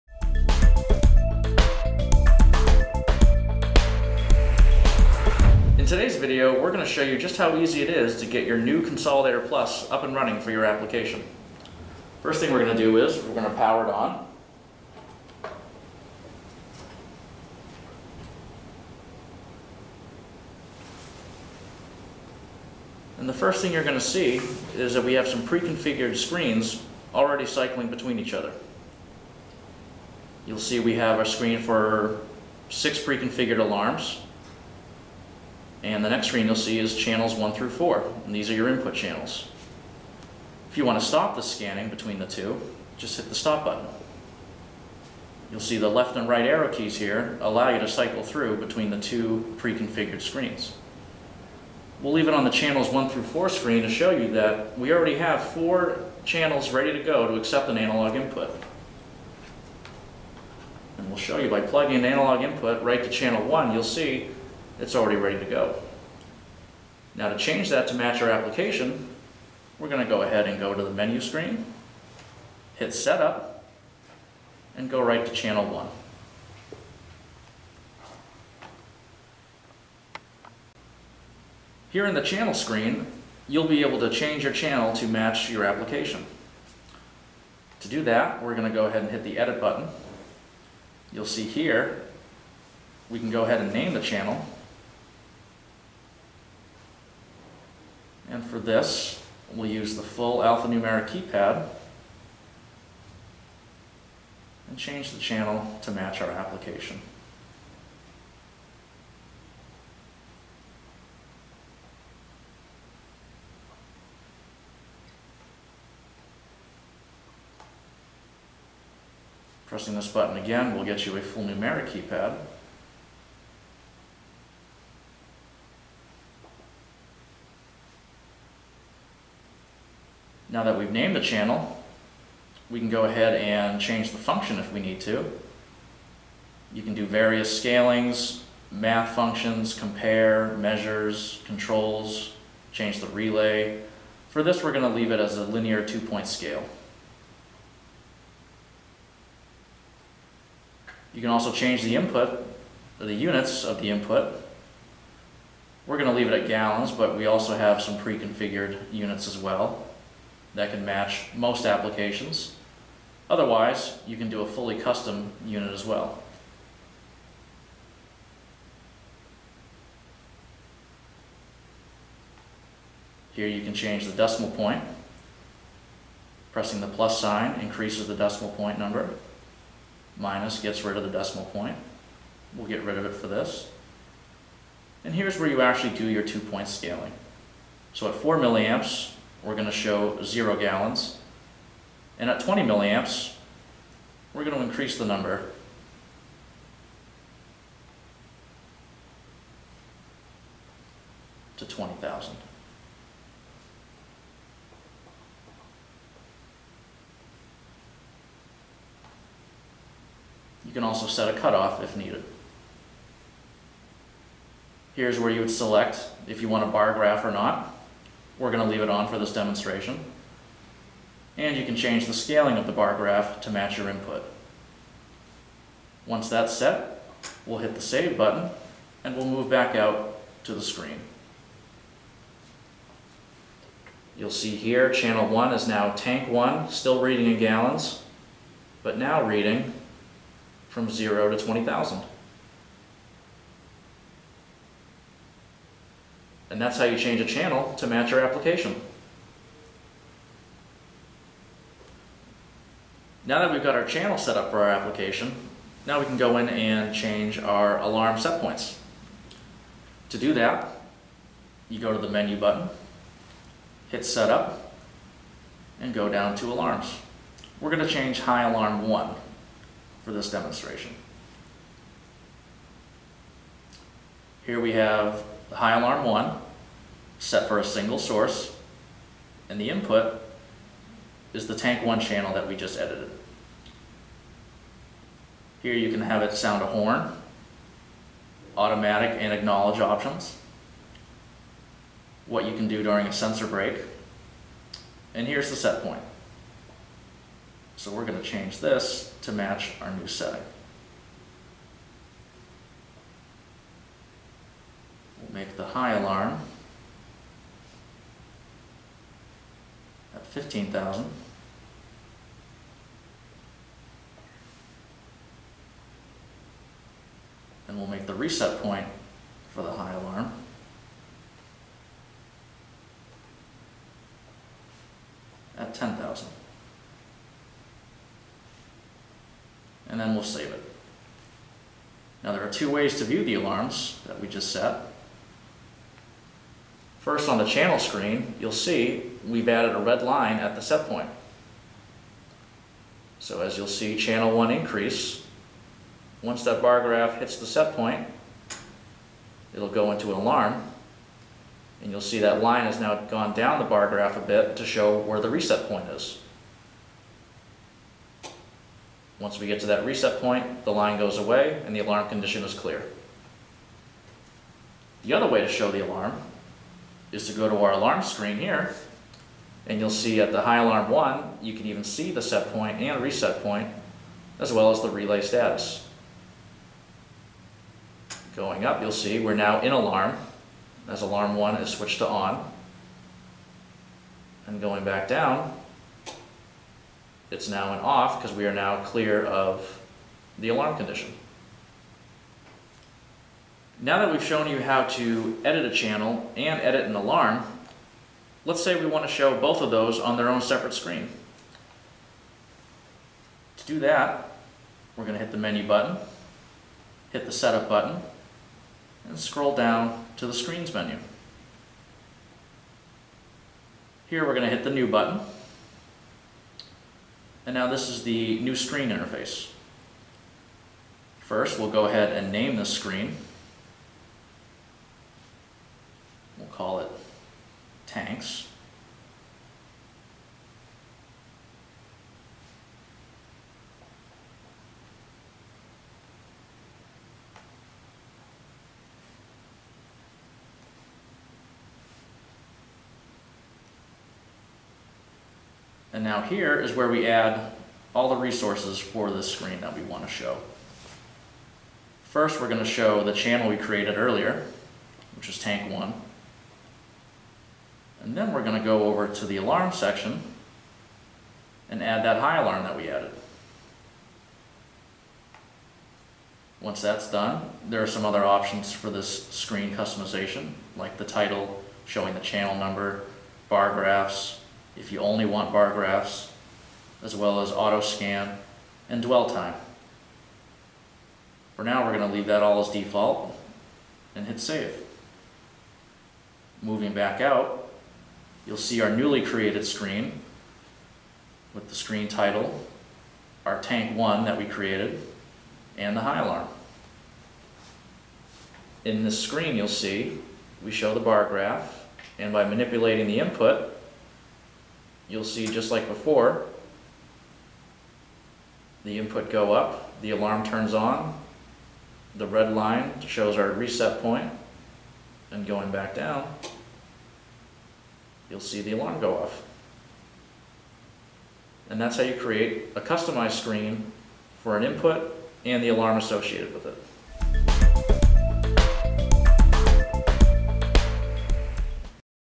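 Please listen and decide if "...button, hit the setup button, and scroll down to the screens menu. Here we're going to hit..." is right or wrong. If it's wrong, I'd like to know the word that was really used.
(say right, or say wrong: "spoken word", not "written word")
right.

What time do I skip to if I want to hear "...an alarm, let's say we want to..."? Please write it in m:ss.
6:36.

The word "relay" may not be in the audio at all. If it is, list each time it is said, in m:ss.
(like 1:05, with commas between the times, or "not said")
2:23, 6:14.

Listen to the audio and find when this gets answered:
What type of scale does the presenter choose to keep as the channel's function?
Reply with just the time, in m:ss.
2:25.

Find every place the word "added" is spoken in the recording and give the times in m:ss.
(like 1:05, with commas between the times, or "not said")
5:39, 7:42.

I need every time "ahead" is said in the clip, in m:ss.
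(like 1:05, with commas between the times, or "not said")
1:10, 1:28, 1:33, 2:13, 7:01.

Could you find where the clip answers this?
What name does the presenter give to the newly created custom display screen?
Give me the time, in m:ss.
7:07.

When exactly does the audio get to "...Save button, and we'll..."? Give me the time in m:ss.
3:47.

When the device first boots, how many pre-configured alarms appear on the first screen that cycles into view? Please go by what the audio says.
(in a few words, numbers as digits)
6.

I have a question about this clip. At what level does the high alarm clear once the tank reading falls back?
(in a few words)
10,000.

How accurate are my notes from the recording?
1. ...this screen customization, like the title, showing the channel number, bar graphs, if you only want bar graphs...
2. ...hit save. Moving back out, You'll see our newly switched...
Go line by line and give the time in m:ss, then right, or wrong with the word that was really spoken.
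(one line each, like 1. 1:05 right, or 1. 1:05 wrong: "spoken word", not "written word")
1. 7:48 right
2. 8:04 wrong: "created", not "switched".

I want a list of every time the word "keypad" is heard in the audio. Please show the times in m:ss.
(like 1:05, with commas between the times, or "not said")
1:41, 2:01.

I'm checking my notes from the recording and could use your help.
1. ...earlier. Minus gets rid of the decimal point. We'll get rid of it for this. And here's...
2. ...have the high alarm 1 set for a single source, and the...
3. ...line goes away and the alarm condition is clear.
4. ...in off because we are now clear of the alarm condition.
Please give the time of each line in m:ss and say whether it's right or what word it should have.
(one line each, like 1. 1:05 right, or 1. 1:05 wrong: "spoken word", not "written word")
1. 2:58 wrong: "number", not "earlier"
2. 4:34 right
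3. 6:00 right
4. 6:27 right.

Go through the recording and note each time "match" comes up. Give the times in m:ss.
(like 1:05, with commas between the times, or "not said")
1:07, 1:25, 1:45, 2:40, 3:43, 4:07, 4:59.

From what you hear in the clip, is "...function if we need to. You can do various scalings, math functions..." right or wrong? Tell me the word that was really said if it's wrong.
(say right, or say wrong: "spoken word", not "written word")
right.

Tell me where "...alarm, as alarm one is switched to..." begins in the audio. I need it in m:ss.
6:19.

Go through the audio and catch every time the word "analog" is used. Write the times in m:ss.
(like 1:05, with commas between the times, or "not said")
0:57, 1:02.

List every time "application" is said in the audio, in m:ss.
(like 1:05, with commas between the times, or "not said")
0:10, 1:08, 1:25, 1:46, 2:41, 4:08, 4:14.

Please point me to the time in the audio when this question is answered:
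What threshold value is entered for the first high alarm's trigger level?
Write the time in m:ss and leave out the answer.
5:10.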